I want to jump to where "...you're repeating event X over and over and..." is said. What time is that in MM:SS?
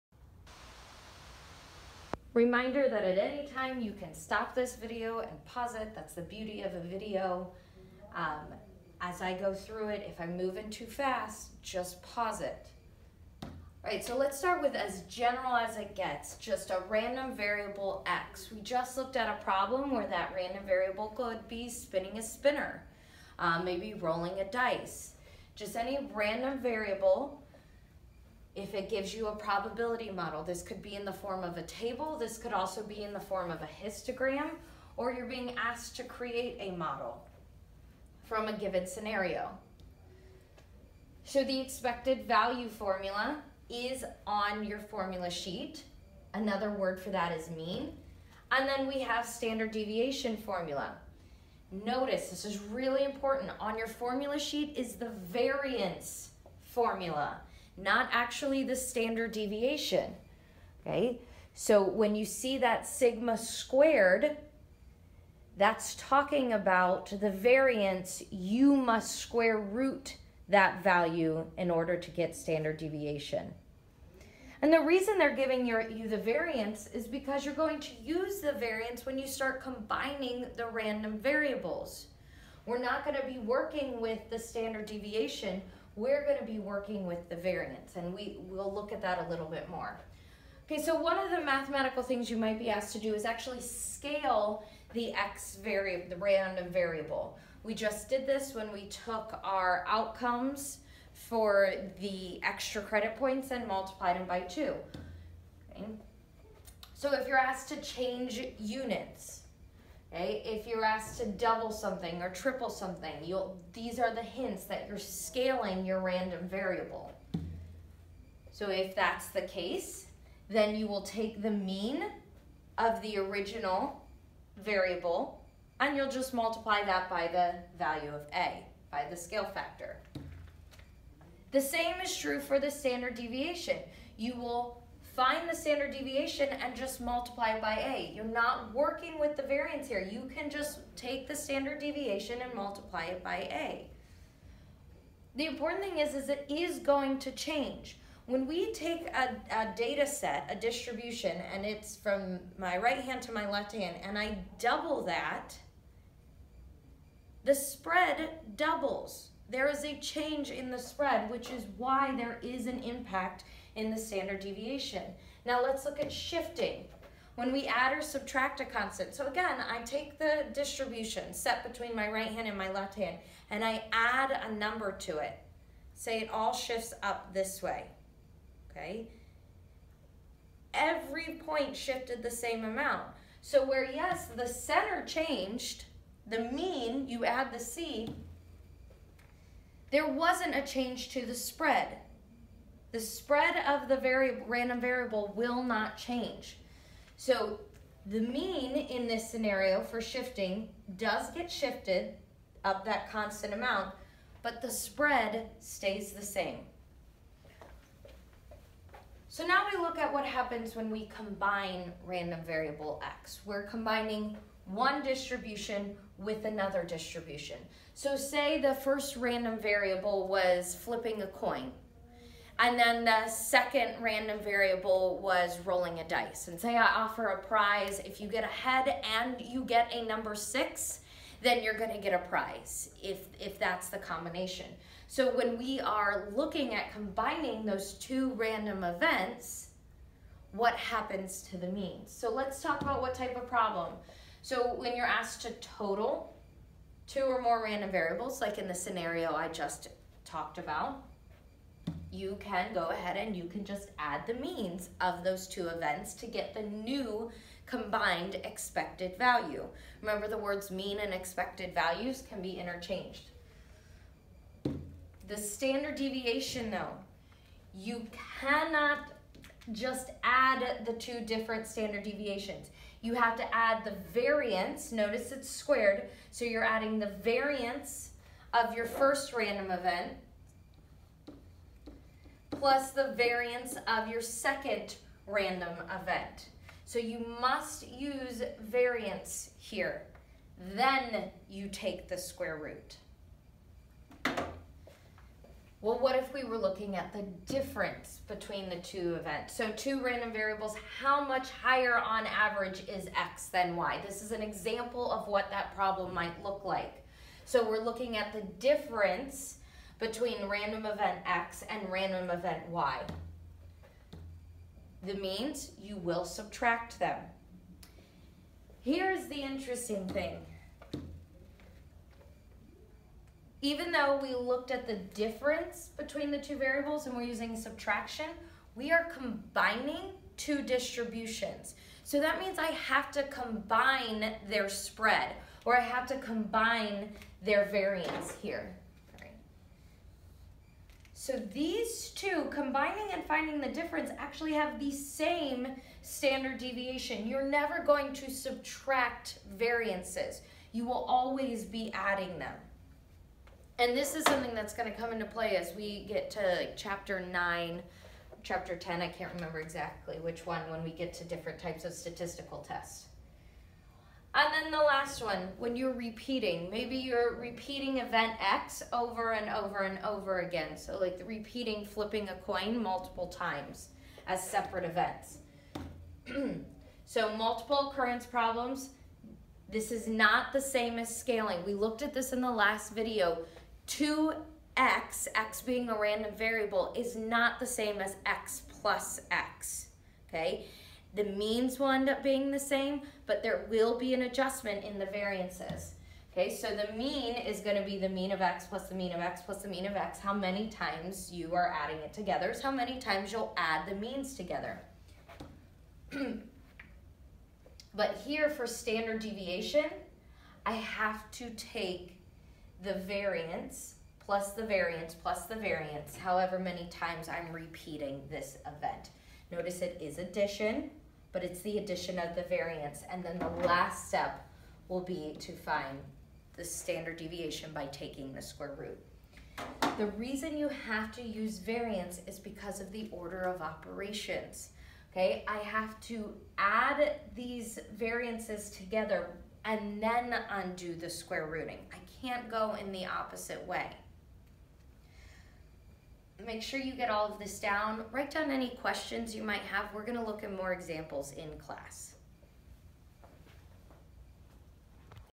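06:06.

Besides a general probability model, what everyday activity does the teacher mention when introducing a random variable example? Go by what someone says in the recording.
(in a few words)
spinning a spinner.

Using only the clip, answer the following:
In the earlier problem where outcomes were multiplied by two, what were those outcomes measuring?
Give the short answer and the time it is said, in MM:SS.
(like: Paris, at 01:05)
extra credit points, at 01:42.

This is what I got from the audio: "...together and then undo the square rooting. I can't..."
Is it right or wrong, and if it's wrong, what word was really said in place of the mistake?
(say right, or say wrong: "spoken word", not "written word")
right.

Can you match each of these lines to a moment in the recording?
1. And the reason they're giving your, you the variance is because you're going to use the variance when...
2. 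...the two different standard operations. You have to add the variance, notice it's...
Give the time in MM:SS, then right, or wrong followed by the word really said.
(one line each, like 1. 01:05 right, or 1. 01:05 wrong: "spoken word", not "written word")
1. 01:14 right
2. 04:30 wrong: "deviations", not "operations".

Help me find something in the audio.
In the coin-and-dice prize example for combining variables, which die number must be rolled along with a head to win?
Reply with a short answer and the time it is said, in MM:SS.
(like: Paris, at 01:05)
6, at 03:50.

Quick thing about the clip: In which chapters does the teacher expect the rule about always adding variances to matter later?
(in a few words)
chapter 9 or 10.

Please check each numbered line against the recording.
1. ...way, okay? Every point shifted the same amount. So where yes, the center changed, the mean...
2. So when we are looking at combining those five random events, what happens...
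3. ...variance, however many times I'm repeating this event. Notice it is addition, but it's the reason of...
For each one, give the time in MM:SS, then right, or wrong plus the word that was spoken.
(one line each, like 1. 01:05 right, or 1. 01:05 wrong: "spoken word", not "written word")
1. 02:57 right
2. 03:55 wrong: "two", not "five"
3. 06:55 wrong: "addition", not "reason".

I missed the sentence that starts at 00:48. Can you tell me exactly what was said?
And then we have standard deviation formula.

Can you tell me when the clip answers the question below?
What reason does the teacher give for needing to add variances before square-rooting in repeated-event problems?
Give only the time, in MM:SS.
07:13.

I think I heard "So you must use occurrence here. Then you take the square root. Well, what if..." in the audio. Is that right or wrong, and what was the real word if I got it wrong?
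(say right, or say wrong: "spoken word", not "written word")
wrong: "variance", not "occurrence".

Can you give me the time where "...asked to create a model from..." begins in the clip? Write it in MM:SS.
00:35.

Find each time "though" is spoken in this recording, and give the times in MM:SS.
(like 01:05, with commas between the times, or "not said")
04:26, 05:23.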